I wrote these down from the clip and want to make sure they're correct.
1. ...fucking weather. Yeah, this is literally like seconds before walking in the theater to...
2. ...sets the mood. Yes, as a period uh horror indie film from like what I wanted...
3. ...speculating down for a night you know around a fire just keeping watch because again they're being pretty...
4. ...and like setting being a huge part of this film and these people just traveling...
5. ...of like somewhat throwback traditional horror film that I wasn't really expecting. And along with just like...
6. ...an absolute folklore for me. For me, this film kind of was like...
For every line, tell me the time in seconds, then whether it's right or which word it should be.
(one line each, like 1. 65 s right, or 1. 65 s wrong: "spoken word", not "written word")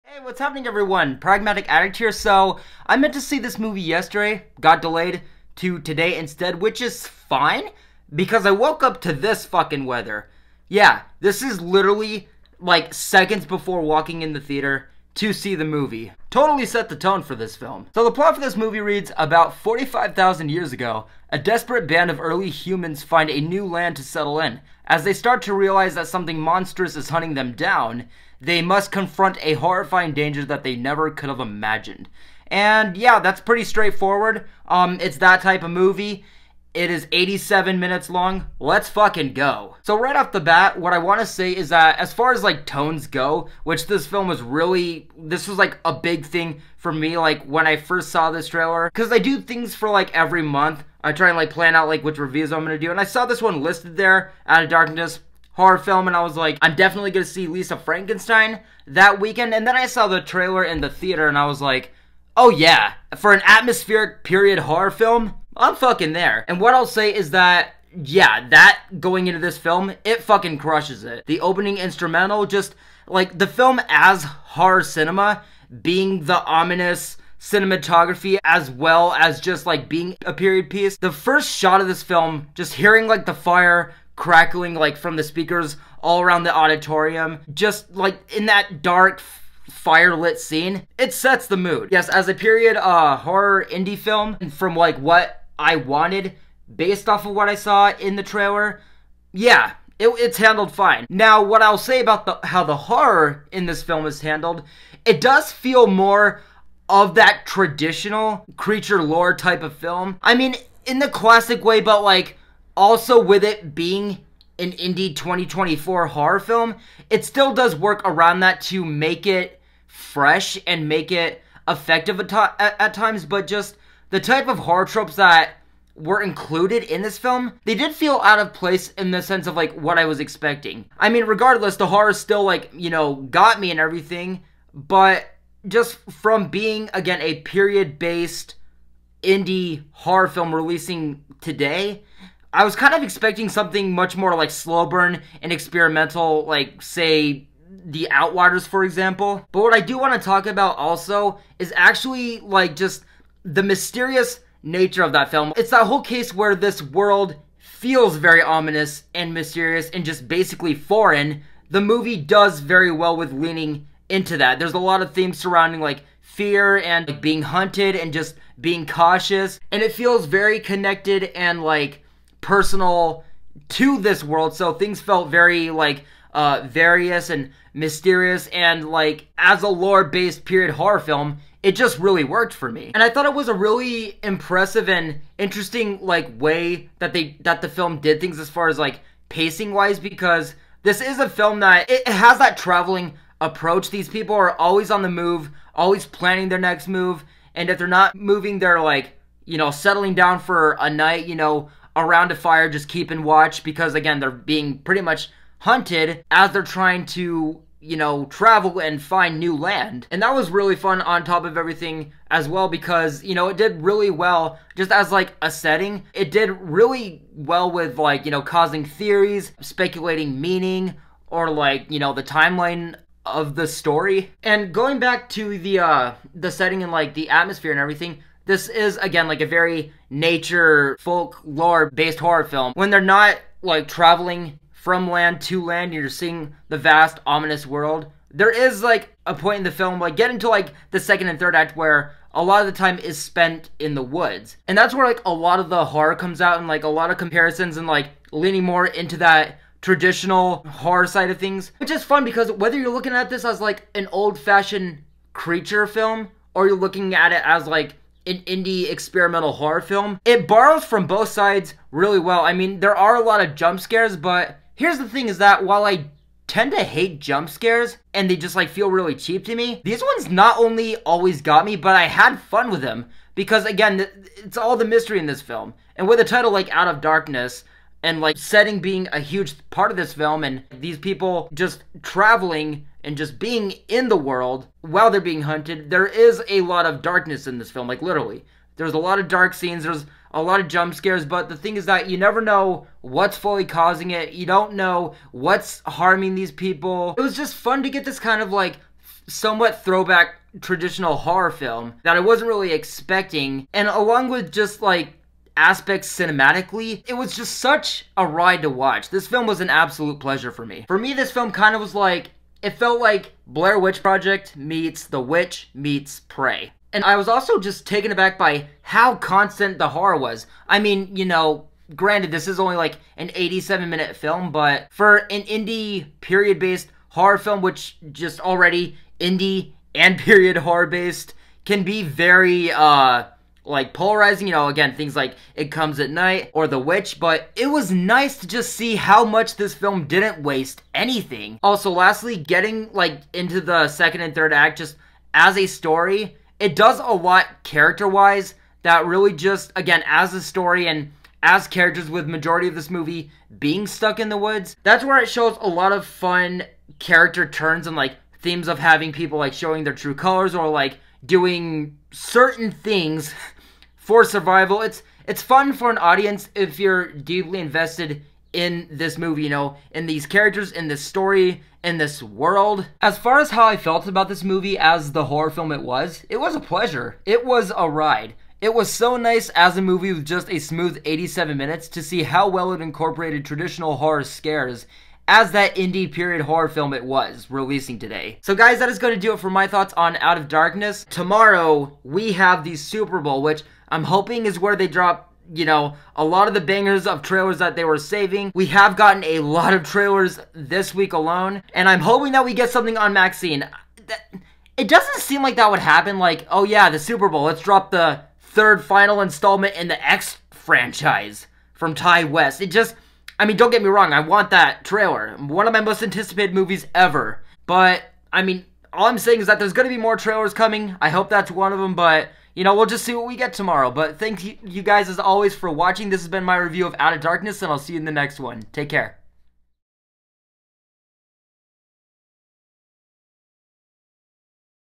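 1. 9 s right
2. 91 s right
3. 199 s wrong: "settling", not "speculating"
4. 278 s right
5. 298 s right
6. 309 s wrong: "pleasure", not "folklore".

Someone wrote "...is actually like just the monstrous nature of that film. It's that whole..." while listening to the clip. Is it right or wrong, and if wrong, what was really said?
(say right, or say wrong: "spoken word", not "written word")
wrong: "mysterious", not "monstrous".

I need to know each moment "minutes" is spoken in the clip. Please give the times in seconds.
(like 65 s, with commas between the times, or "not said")
37 s, 323 s, 381 s.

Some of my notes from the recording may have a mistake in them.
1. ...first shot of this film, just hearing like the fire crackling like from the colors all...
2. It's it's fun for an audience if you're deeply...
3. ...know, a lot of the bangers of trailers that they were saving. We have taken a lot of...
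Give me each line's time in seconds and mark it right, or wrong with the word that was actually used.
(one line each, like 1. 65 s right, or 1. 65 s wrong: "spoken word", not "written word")
1. 81 s wrong: "speakers", not "colors"
2. 364 s right
3. 395 s wrong: "gotten", not "taken".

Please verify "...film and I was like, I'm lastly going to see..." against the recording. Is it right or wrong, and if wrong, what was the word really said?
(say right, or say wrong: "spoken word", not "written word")
wrong: "definitely", not "lastly".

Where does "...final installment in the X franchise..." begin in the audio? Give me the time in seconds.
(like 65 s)
408 s.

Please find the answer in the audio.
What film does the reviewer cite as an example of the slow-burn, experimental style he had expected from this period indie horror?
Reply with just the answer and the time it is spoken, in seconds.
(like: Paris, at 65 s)
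The Outwaters, at 147 s.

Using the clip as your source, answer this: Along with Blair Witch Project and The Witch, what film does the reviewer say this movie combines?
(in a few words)
Prey.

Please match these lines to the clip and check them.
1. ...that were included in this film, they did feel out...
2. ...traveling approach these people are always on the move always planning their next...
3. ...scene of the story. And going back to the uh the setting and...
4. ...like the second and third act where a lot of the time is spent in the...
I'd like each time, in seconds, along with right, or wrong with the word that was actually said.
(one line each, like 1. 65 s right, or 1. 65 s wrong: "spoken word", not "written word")
1. 125 s right
2. 192 s right
3. 222 s wrong: "timeline", not "scene"
4. 240 s right.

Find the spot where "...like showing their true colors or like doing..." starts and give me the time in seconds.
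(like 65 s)
359 s.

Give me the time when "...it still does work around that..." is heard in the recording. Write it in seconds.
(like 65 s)
117 s.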